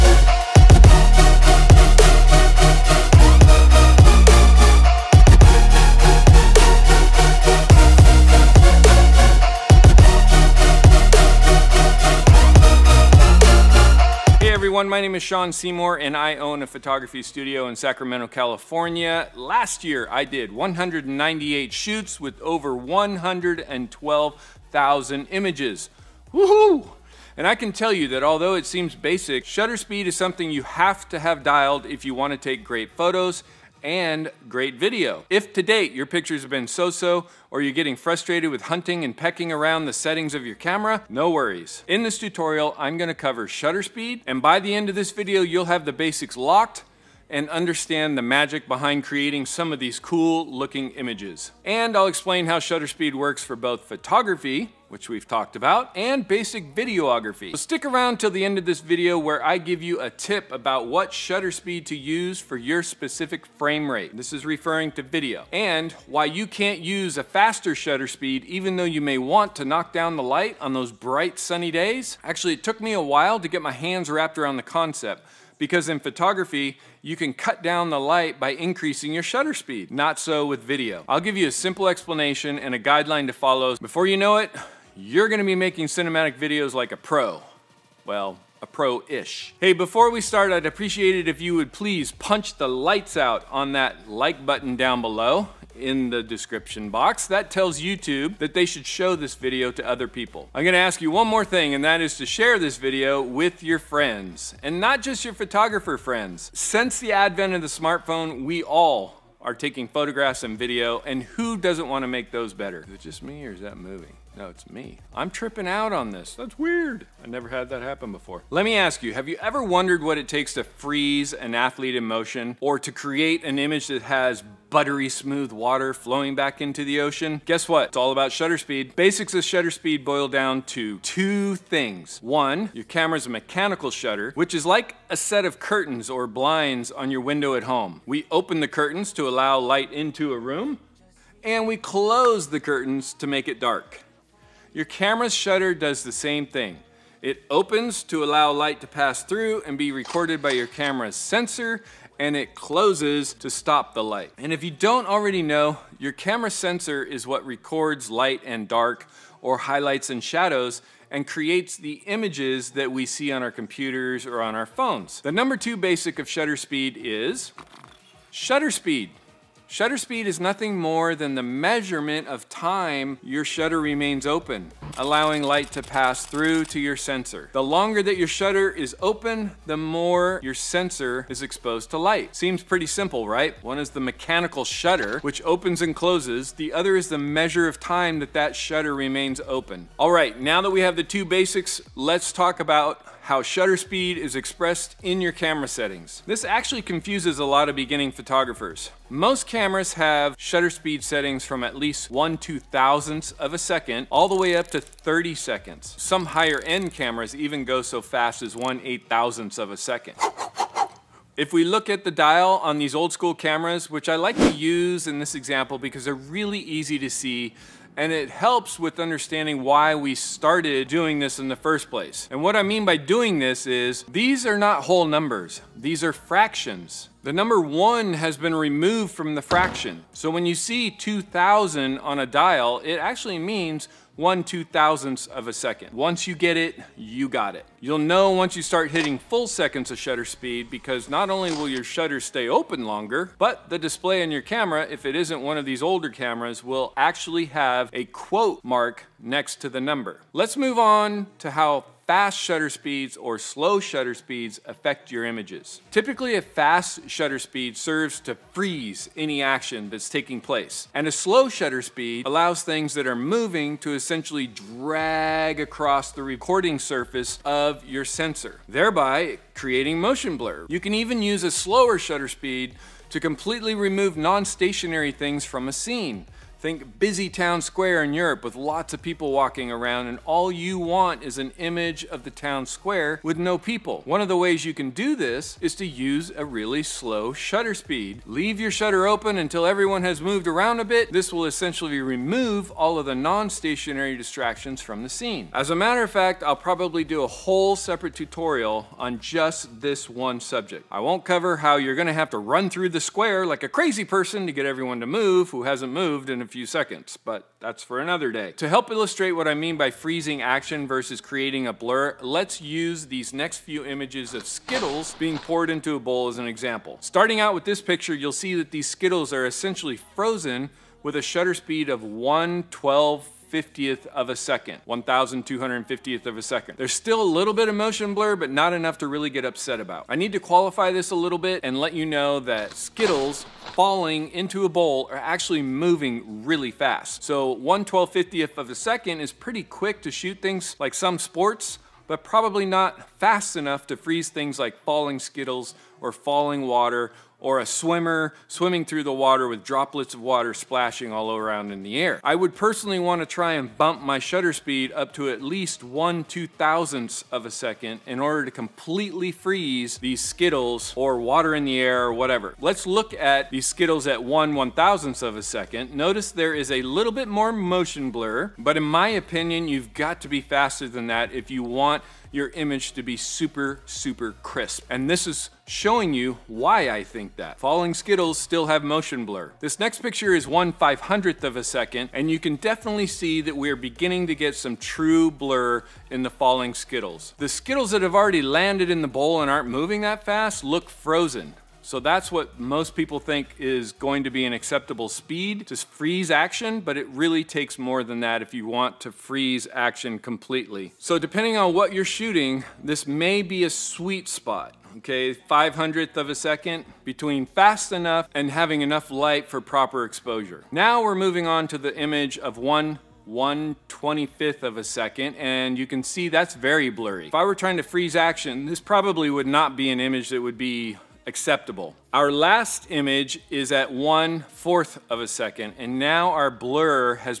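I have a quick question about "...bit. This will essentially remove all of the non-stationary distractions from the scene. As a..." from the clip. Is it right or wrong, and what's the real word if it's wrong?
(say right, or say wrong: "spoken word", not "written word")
right.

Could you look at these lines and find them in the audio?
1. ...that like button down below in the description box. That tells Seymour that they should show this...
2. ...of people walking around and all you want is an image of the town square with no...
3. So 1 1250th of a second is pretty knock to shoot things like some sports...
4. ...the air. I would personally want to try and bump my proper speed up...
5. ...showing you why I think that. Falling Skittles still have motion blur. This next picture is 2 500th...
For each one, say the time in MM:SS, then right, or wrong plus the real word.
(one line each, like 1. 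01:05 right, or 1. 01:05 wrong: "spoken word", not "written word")
1. 01:33 wrong: "YouTube", not "Seymour"
2. 04:38 right
3. 05:37 wrong: "quick", not "knock"
4. 05:51 wrong: "shutter", not "proper"
5. 06:15 wrong: "1", not "2".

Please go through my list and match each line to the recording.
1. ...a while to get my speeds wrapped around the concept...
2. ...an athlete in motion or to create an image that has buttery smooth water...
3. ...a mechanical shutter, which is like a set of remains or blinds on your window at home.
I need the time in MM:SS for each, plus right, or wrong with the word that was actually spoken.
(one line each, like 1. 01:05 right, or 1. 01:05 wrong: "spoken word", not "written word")
1. 01:12 wrong: "hands", not "speeds"
2. 02:01 right
3. 02:13 wrong: "curtains", not "remains".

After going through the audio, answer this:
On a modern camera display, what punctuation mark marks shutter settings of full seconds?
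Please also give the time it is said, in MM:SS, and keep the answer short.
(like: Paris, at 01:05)
Quote mark, at 04:08.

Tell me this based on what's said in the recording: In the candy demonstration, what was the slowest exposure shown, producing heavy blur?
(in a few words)
1/4 second.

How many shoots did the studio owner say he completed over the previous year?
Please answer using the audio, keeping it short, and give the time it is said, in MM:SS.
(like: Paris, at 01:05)
198, at 00:20.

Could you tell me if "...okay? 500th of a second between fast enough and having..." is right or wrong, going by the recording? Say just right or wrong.
right.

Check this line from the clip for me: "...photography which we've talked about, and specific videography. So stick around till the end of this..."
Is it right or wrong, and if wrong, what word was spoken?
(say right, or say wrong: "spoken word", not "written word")
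wrong: "basic", not "specific".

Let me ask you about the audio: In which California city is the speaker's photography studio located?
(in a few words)
Sacramento.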